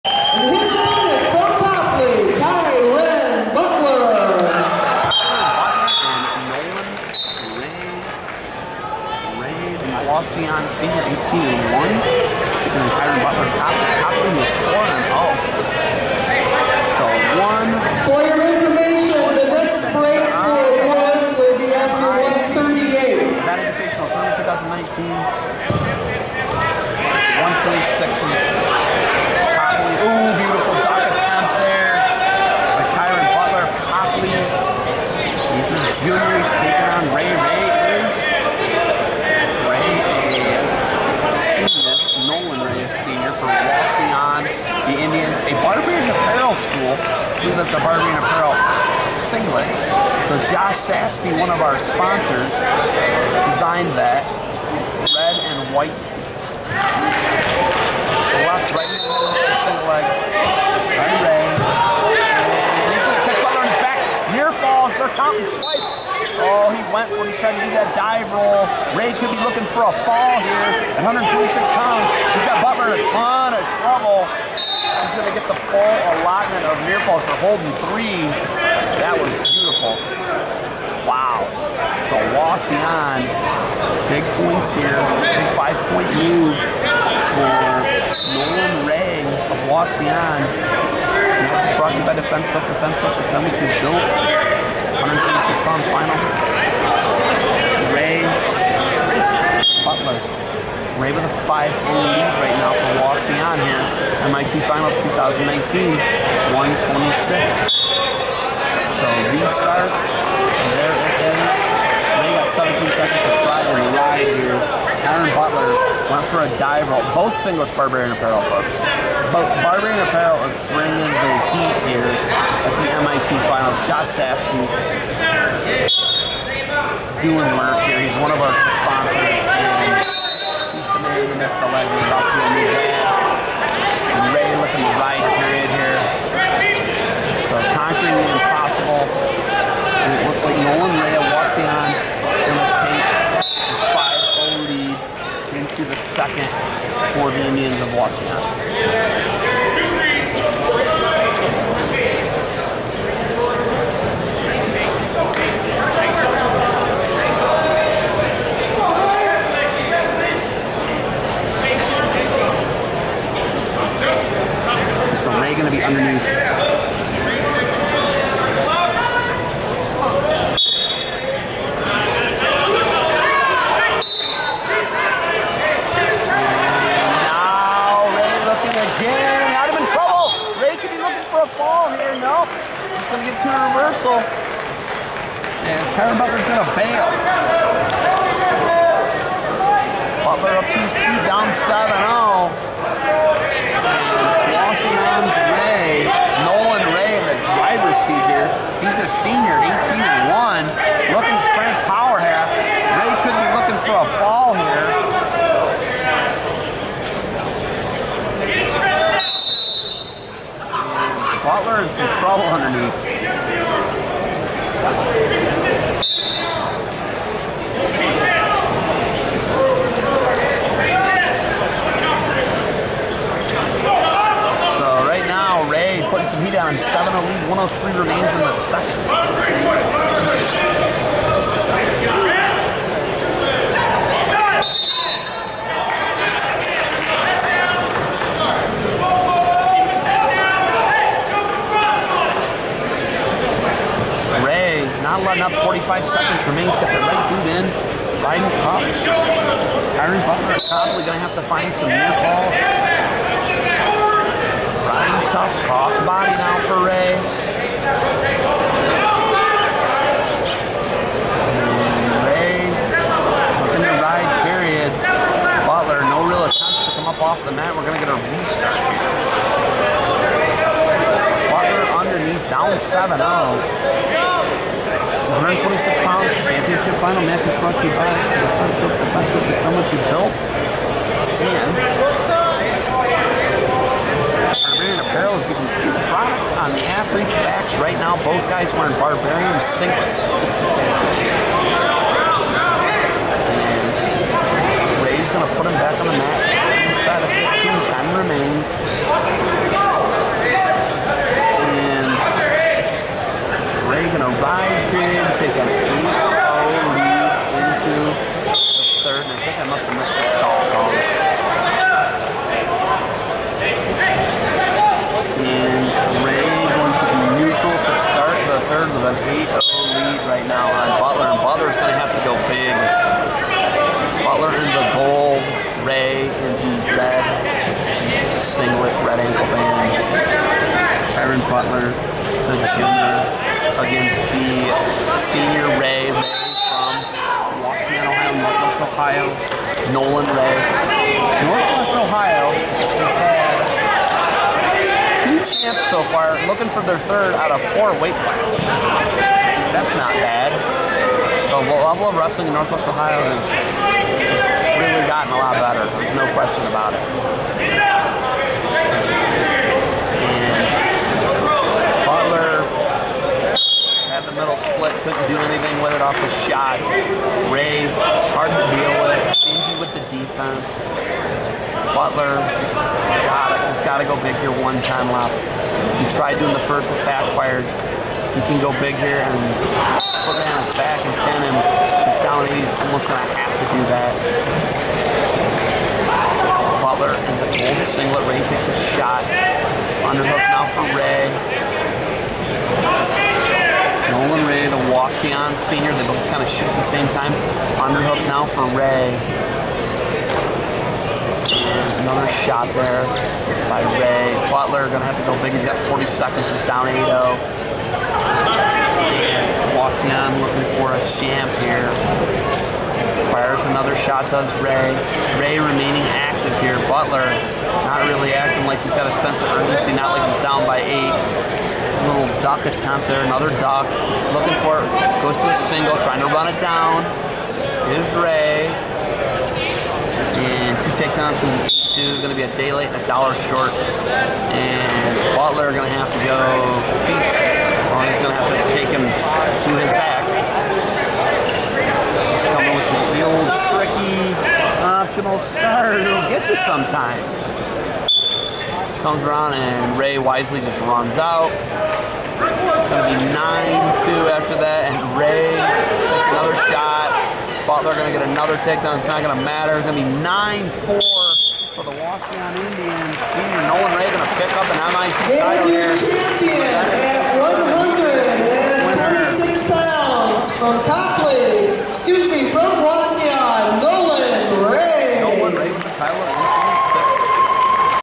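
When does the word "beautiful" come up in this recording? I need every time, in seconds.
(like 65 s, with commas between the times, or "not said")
79 s.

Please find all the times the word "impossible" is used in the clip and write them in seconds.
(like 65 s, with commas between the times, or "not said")
138 s.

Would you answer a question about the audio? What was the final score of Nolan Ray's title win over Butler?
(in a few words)
9-4.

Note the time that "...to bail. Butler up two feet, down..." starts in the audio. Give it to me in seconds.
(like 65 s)
186 s.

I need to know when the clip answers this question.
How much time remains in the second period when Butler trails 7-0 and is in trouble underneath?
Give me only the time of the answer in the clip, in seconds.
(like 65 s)
227 s.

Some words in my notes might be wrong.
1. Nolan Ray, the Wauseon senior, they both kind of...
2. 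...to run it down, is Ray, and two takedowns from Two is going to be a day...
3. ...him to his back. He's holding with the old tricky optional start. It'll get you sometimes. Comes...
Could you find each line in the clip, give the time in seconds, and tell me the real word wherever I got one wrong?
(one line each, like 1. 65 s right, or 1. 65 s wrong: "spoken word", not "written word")
1. 394 s right
2. 426 s right
3. 438 s wrong: "coming", not "holding".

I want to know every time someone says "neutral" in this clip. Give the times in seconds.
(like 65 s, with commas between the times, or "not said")
317 s.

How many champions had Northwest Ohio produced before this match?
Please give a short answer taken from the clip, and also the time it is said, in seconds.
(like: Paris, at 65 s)
2, at 345 s.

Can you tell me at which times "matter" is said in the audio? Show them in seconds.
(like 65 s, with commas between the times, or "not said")
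459 s.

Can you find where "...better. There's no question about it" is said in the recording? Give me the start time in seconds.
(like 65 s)
355 s.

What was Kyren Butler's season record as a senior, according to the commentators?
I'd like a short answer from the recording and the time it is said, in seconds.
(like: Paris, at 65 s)
18-1, at 199 s.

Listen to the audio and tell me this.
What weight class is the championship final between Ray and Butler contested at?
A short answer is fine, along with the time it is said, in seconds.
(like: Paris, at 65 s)
126 pounds, at 95 s.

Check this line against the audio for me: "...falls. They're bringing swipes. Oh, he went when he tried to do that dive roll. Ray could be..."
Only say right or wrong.
wrong.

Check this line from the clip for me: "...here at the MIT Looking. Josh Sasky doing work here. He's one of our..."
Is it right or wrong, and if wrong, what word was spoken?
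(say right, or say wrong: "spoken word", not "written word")
wrong: "Finals", not "Looking".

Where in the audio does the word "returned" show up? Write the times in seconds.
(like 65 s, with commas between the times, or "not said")
not said.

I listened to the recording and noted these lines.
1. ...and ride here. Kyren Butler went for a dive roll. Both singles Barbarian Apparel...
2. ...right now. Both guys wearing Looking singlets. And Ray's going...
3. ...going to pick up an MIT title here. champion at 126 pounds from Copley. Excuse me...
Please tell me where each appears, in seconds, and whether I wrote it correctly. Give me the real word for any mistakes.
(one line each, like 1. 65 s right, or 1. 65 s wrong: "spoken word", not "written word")
1. 113 s right
2. 287 s wrong: "Barbarian", not "Looking"
3. 464 s right.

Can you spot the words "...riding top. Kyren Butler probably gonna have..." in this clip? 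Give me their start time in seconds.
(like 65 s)
248 s.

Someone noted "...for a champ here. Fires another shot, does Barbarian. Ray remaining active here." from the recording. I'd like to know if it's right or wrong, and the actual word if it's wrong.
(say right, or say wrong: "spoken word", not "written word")
wrong: "Ray", not "Barbarian".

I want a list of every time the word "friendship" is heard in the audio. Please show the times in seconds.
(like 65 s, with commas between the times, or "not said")
278 s.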